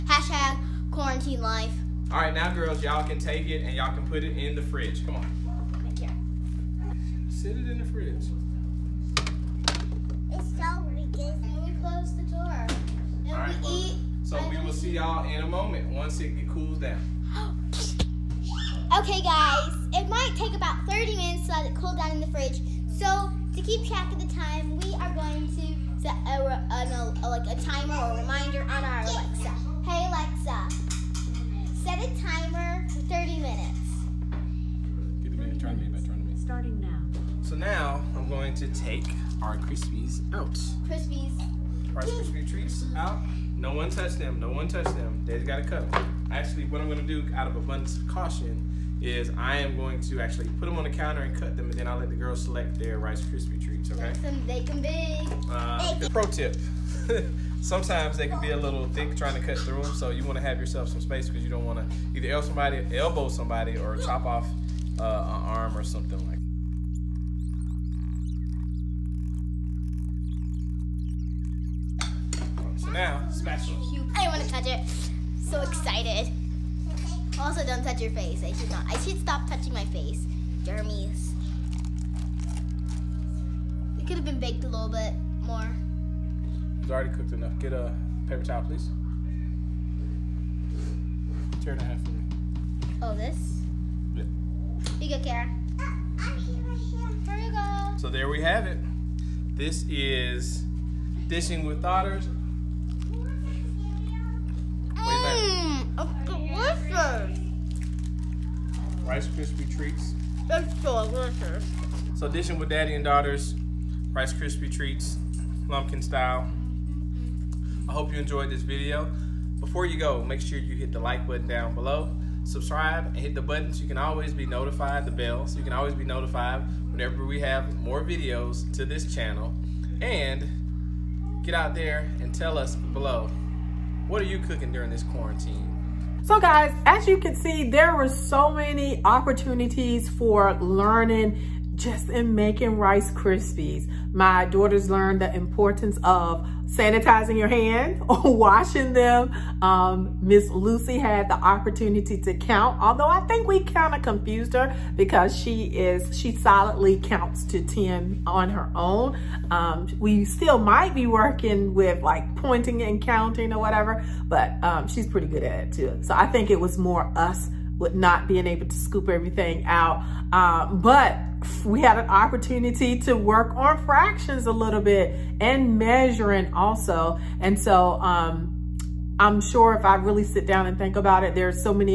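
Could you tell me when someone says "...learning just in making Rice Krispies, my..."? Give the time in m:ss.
2:20.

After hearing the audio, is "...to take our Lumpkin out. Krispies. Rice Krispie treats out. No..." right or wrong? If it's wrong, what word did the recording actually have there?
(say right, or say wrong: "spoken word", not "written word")
wrong: "Krispies", not "Lumpkin".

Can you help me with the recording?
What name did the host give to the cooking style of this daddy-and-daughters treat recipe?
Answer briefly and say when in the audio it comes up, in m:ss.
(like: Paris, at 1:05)
Lumpkin style, at 1:55.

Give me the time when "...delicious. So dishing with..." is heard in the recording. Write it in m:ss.
1:51.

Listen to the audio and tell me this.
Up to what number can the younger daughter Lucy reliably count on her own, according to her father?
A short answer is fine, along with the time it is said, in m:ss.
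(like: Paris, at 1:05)
10, at 2:37.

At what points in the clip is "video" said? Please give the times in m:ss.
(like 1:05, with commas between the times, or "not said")
1:58, 2:08.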